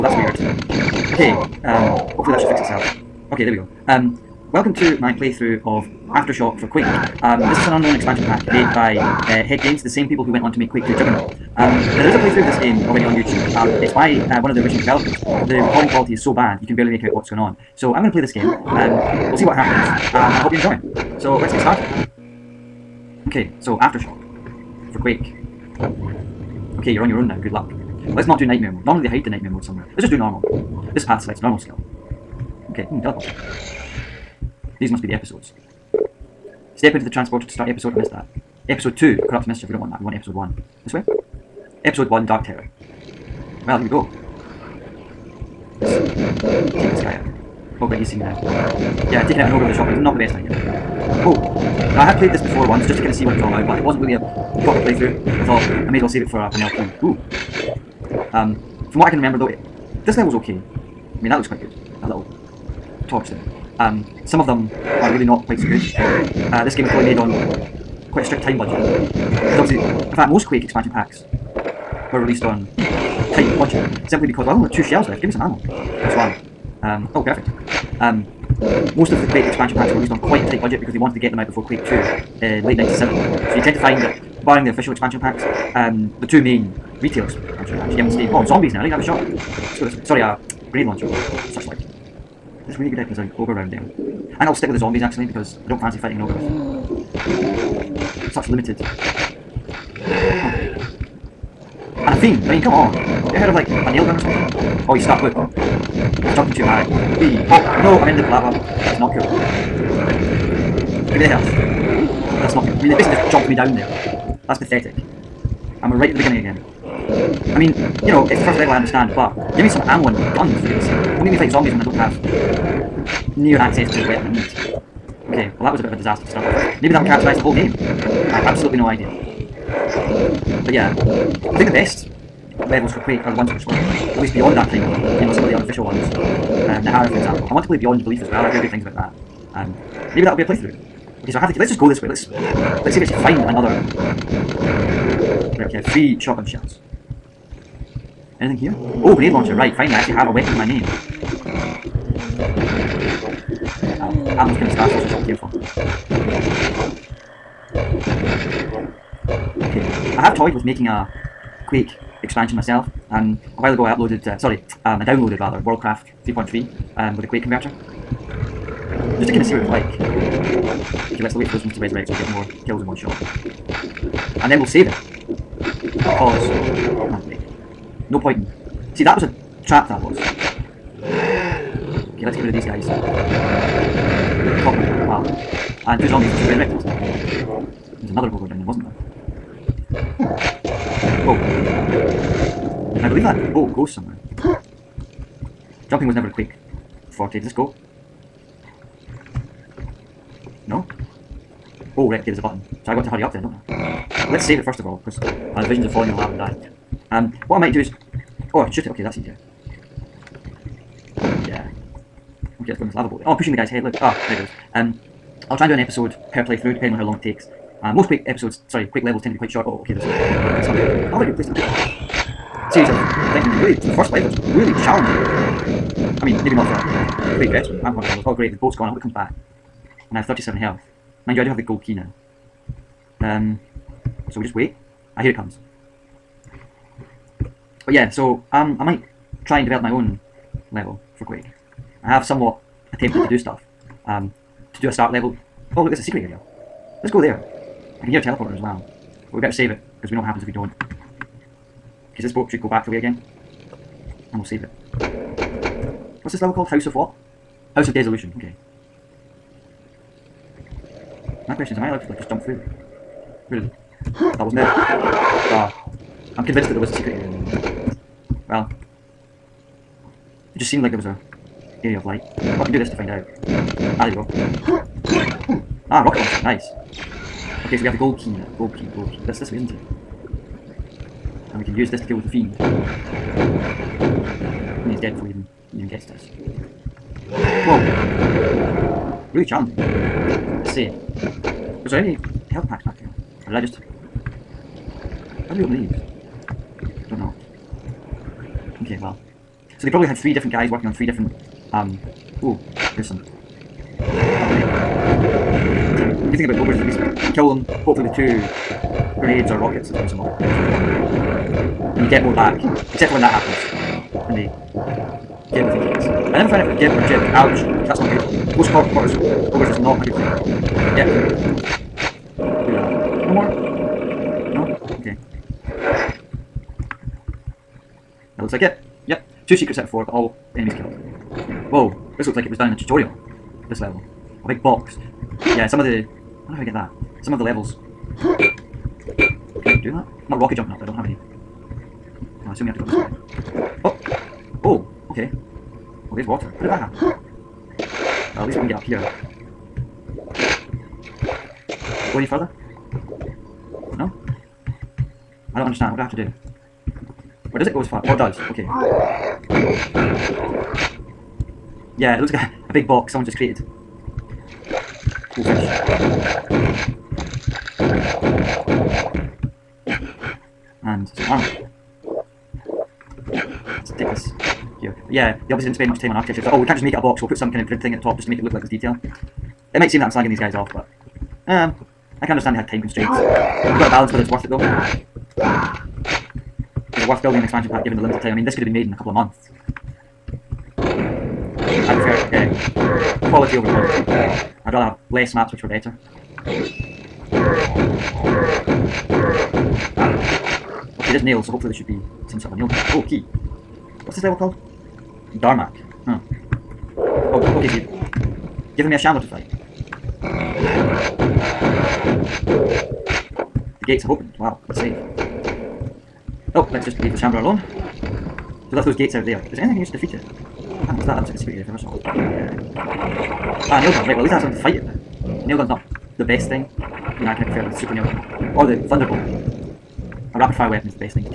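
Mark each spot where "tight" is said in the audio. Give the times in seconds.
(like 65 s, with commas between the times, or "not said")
72 s, 80 s.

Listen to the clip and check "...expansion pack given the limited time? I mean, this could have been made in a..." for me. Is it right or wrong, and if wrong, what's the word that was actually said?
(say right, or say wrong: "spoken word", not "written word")
right.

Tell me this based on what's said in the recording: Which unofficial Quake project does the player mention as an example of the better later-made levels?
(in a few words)
Nehahra.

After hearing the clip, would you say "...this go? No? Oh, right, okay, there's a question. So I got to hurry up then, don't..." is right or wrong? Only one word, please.
wrong.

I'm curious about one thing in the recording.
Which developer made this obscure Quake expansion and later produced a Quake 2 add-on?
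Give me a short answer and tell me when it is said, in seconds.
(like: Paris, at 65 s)
Head Games, at 9 s.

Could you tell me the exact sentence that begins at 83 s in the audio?
So you tend to find that, barring the official expansion packs, um, the two main retail Actually, yeah, Steve.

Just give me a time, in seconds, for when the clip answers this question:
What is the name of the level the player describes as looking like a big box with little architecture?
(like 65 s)
405 s.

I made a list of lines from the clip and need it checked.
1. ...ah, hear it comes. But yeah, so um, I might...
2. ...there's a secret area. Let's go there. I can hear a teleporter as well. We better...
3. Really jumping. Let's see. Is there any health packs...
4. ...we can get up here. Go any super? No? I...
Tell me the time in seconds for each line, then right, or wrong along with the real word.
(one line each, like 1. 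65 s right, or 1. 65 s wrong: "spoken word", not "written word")
1. 235 s right
2. 245 s right
3. 289 s wrong: "challenging", not "jumping"
4. 348 s wrong: "further", not "super".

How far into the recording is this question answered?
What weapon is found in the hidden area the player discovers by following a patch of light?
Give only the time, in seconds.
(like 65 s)
276 s.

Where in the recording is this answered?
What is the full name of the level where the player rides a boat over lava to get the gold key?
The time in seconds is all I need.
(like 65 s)
257 s.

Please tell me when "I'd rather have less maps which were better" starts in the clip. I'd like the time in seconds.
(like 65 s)
394 s.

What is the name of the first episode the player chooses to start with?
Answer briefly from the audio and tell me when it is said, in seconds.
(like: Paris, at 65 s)
Dark Terror, at 42 s.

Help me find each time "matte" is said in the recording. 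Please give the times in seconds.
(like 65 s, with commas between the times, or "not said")
not said.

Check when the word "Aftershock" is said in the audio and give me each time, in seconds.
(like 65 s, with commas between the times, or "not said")
6 s, 23 s.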